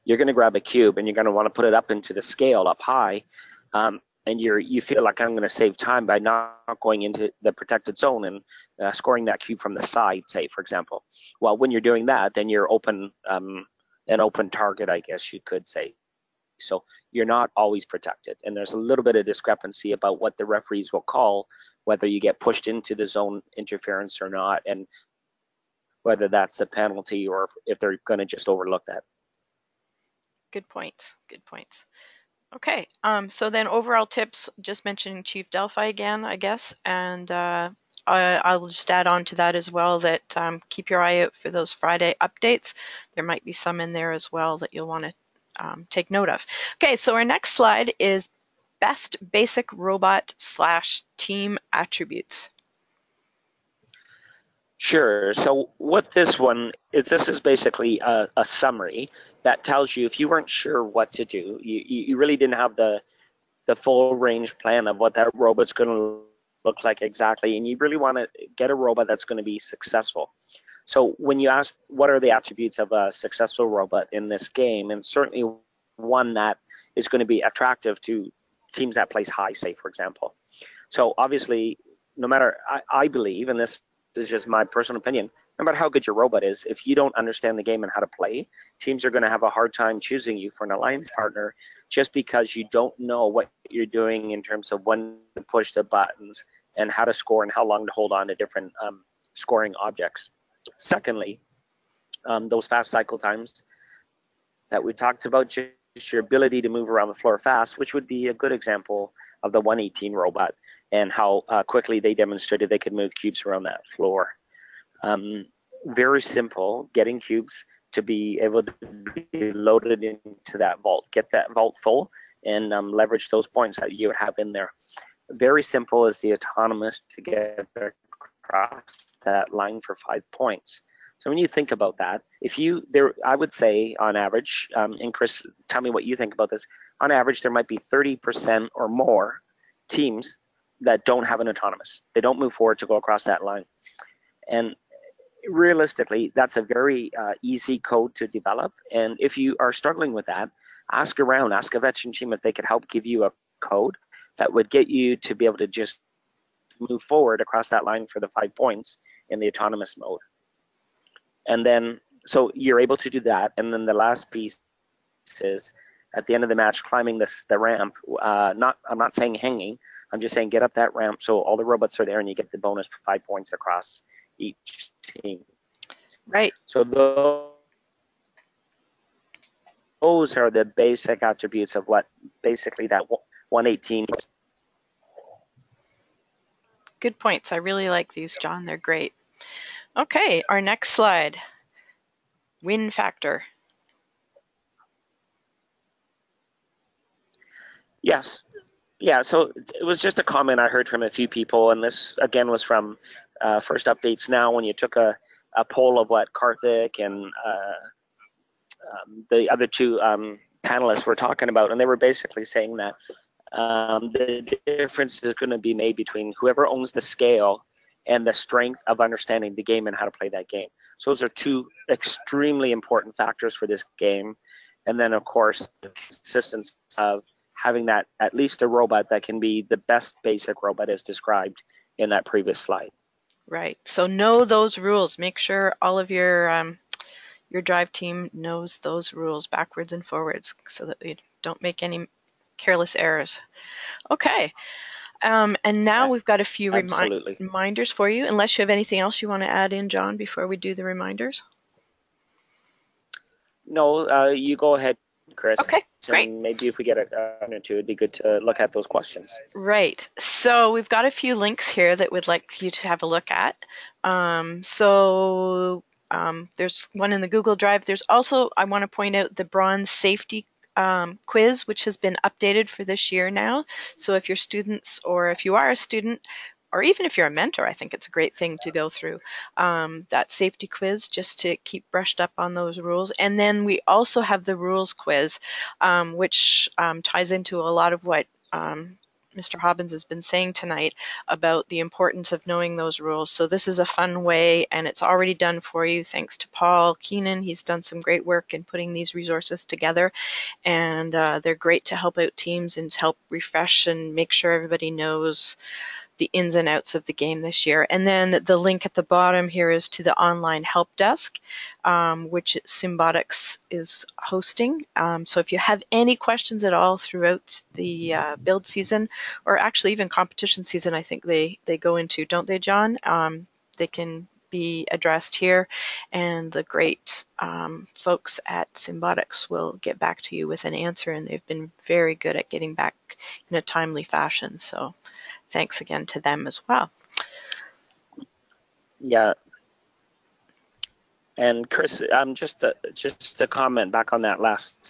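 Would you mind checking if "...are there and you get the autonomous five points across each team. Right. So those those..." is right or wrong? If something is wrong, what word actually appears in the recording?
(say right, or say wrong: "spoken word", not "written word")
wrong: "bonus", not "autonomous".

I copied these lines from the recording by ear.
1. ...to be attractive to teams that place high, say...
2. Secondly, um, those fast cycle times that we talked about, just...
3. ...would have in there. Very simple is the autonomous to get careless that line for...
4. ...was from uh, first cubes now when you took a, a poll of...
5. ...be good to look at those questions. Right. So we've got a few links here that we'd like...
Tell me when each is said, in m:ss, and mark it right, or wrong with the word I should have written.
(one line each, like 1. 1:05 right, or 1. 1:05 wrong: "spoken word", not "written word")
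1. 1:17 right
2. 1:40 right
3. 2:04 wrong: "across", not "careless"
4. 3:22 wrong: "updates", not "cubes"
5. 4:17 right.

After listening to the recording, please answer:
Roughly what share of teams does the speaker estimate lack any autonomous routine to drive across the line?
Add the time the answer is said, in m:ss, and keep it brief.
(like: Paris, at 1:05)
30%, at 2:17.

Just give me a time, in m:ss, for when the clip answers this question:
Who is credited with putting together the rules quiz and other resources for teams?
4:56.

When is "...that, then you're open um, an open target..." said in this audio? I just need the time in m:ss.
0:12.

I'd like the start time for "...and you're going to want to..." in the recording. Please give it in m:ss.
0:00.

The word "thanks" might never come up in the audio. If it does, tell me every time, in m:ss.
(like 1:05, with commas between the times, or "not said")
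4:56, 5:35.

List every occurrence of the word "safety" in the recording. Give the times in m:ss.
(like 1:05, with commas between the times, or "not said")
4:29, 4:40.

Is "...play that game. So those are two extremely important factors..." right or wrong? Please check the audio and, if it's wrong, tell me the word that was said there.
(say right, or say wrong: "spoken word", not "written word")
right.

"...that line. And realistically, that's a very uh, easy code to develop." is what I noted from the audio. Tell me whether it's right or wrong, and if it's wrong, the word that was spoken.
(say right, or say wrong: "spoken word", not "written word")
right.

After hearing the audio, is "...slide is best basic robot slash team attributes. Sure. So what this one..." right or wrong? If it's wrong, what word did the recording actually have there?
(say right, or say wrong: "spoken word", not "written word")
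right.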